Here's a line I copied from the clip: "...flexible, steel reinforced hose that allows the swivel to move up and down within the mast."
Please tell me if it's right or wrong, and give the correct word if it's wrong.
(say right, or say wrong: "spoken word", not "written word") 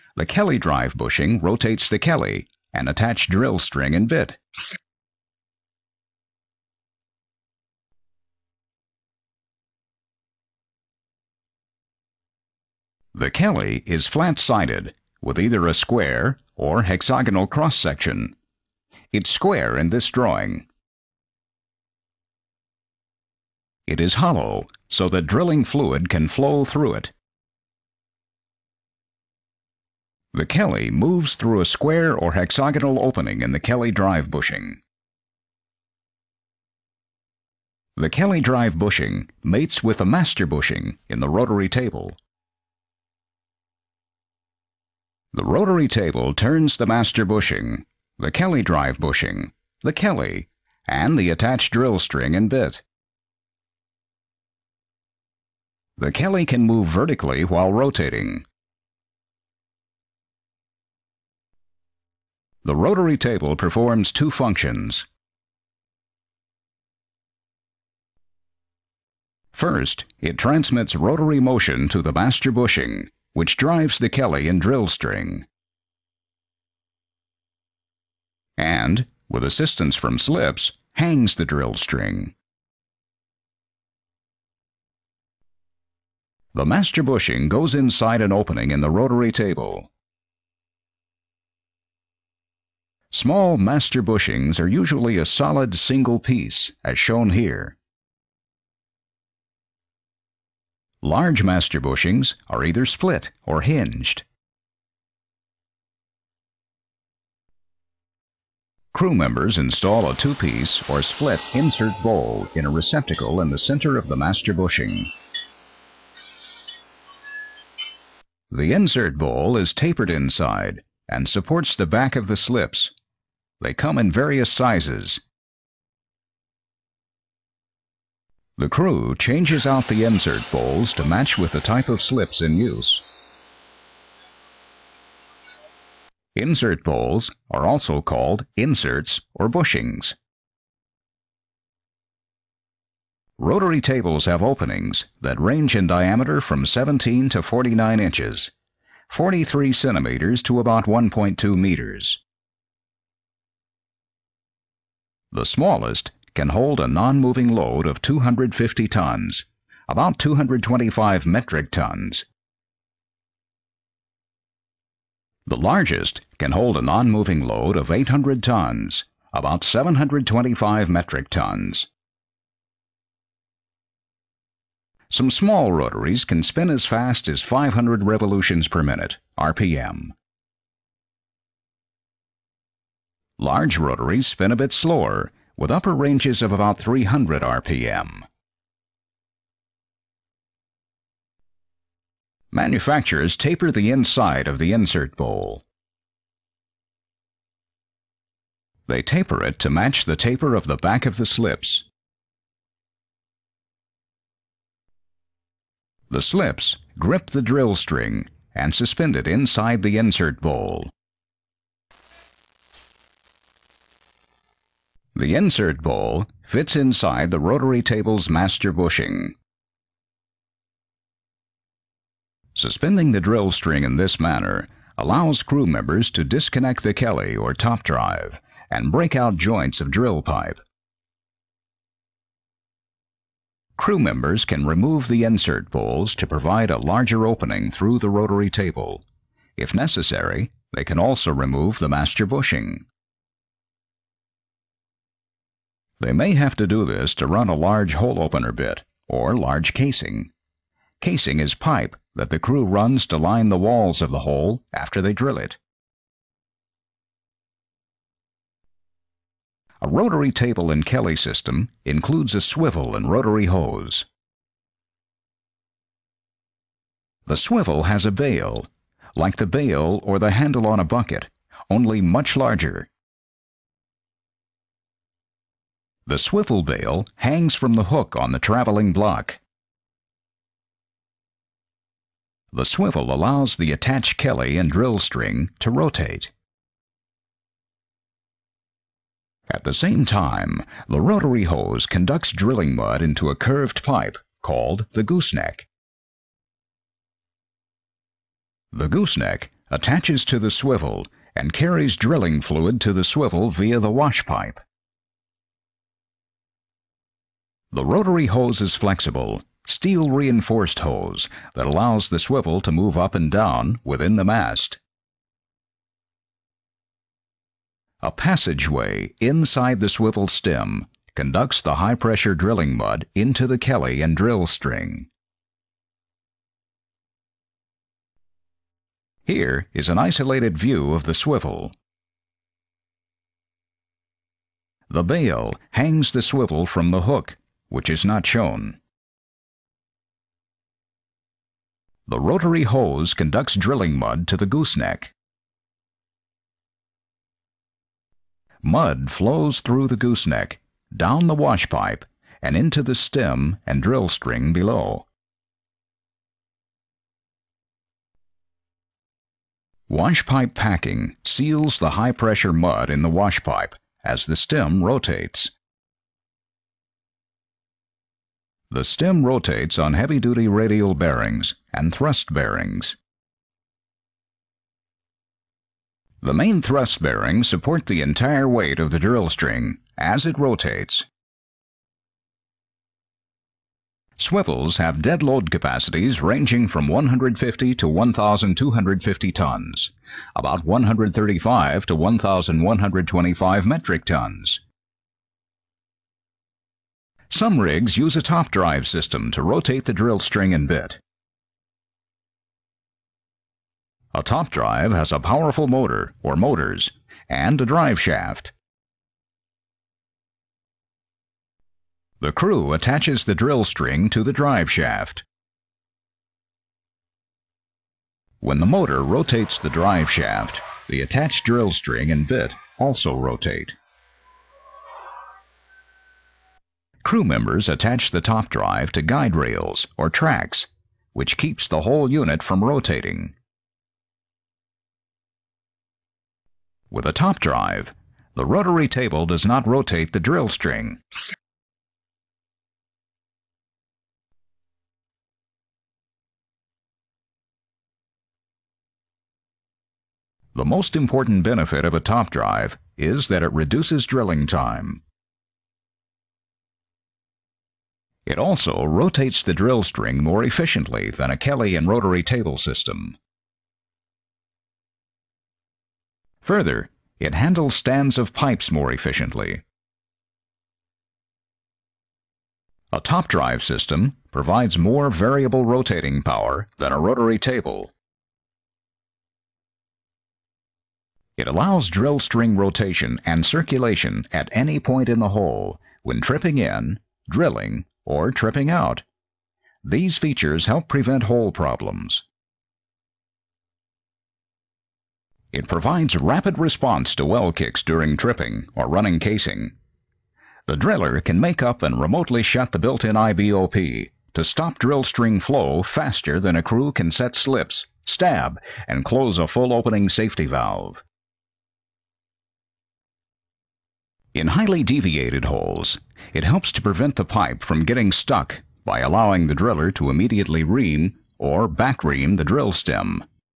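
right.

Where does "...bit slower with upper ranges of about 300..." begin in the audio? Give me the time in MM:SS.
03:04.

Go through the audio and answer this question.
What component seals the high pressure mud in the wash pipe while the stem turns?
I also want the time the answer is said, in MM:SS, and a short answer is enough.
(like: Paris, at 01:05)
wash pipe packing, at 05:59.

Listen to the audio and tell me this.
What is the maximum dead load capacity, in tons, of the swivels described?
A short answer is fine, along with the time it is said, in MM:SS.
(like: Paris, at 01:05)
1,250 tons, at 06:27.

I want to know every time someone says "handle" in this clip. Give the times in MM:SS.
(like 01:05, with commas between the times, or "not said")
04:30, 07:47.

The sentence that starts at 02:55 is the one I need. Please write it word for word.
Some small rotaries can spin as fast as 500 revolutions per minute, RPM.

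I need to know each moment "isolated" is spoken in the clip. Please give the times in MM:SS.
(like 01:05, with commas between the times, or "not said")
05:29.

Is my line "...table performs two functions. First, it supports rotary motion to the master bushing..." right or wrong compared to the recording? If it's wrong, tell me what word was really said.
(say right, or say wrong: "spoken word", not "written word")
wrong: "transmits", not "supports".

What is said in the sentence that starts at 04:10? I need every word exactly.
Casing is pipe that the crew runs to line the walls of the hole after they drill it.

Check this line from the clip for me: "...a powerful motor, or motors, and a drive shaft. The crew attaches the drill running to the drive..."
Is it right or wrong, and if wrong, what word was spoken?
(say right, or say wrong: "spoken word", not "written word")
wrong: "string", not "running".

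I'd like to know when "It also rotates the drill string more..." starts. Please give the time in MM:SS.
07:38.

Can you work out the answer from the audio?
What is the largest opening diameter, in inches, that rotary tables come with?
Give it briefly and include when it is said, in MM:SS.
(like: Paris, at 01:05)
49 inches, at 02:27.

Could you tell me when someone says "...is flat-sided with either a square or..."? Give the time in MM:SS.
00:13.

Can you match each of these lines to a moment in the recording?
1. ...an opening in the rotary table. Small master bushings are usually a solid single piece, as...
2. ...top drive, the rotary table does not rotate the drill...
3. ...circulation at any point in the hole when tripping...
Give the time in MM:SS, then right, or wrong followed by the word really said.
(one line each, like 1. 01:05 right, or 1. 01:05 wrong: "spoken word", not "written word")
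1. 01:28 right
2. 07:17 right
3. 08:03 right.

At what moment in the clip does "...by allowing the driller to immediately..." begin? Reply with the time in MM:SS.
08:38.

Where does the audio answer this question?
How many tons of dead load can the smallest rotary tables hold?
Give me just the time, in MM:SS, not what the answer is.
02:38.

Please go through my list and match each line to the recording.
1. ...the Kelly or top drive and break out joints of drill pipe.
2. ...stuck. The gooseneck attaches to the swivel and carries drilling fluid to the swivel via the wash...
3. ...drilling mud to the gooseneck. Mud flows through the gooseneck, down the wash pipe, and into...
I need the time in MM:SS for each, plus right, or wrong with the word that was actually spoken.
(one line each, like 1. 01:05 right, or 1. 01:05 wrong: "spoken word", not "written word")
1. 03:46 right
2. 04:55 wrong: "gooseneck", not "stuck"
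3. 05:43 right.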